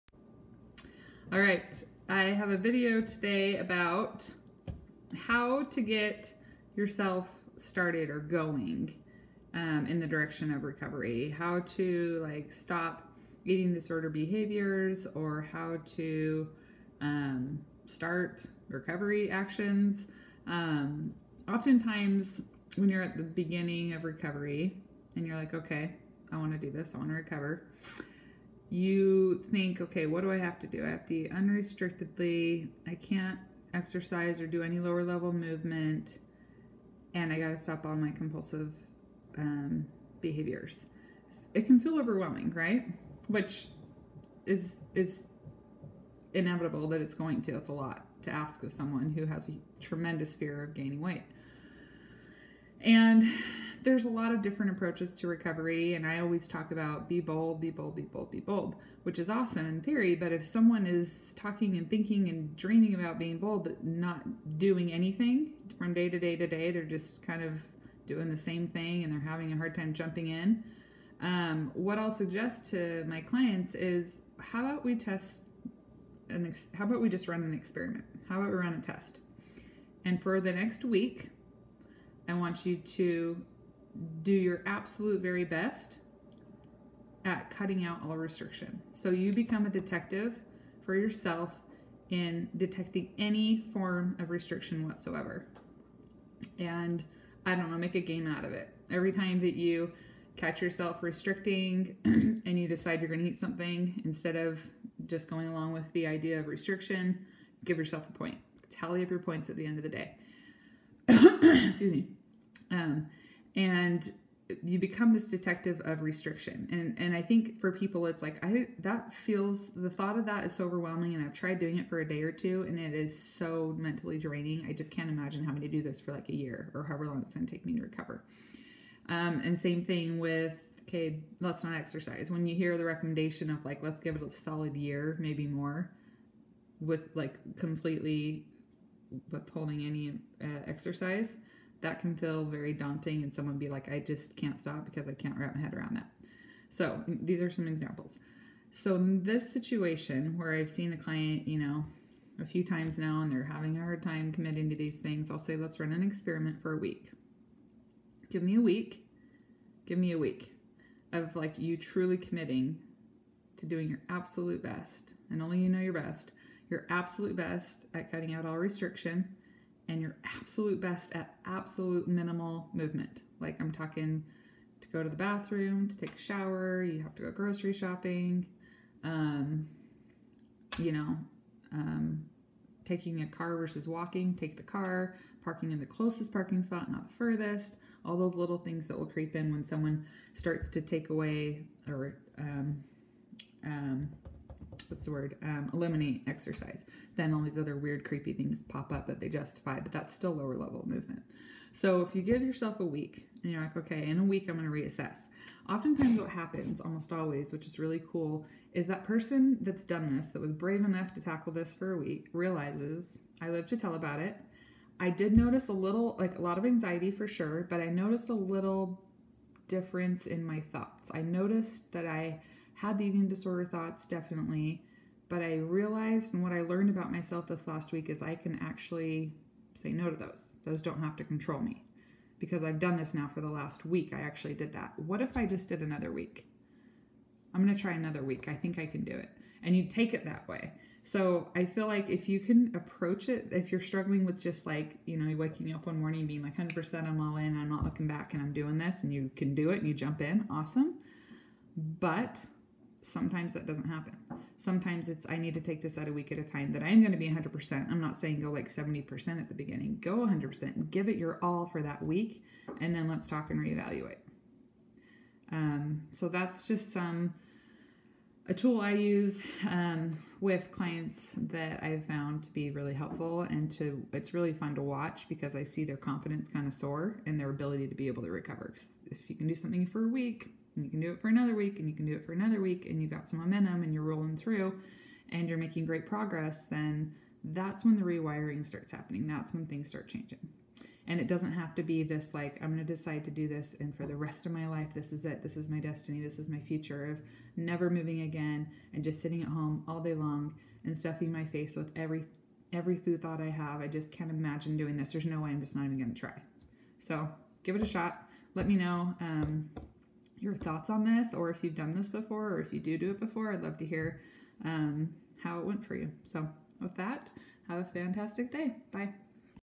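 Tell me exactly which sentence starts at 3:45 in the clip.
But I realized and what I learned about myself this last week is I can actually say no to those.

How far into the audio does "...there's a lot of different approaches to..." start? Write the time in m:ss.
0:53.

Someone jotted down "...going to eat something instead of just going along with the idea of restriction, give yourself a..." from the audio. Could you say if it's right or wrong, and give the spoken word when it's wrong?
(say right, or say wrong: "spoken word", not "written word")
right.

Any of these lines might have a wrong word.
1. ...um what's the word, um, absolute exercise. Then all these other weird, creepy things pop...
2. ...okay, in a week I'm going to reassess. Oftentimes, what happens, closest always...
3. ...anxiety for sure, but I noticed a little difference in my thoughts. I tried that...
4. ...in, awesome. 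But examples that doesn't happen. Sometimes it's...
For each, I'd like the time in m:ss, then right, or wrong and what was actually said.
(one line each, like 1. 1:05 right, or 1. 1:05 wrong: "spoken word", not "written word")
1. 3:13 wrong: "eliminate", not "absolute"
2. 3:23 wrong: "almost", not "closest"
3. 3:36 wrong: "noticed", not "tried"
4. 4:10 wrong: "sometimes", not "examples".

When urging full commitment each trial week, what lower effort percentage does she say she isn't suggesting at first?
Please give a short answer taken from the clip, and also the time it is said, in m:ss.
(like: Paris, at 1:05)
70%, at 4:18.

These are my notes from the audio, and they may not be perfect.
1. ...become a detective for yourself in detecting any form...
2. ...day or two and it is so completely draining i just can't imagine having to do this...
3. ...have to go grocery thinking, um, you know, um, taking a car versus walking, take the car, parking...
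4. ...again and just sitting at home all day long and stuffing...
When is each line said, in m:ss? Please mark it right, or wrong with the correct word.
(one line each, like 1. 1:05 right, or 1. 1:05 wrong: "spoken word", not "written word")
1. 1:29 right
2. 2:02 wrong: "mentally", not "completely"
3. 2:57 wrong: "shopping", not "thinking"
4. 4:58 right.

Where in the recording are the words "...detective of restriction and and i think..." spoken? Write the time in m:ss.
1:55.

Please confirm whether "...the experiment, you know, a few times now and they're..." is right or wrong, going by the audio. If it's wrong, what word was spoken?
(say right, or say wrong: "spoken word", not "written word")
wrong: "client", not "experiment".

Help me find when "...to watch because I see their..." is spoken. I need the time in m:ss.
4:34.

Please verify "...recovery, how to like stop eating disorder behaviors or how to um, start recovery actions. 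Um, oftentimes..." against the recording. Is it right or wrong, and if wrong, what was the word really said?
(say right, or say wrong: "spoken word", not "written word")
right.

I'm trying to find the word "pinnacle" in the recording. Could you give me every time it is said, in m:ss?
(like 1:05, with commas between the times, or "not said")
not said.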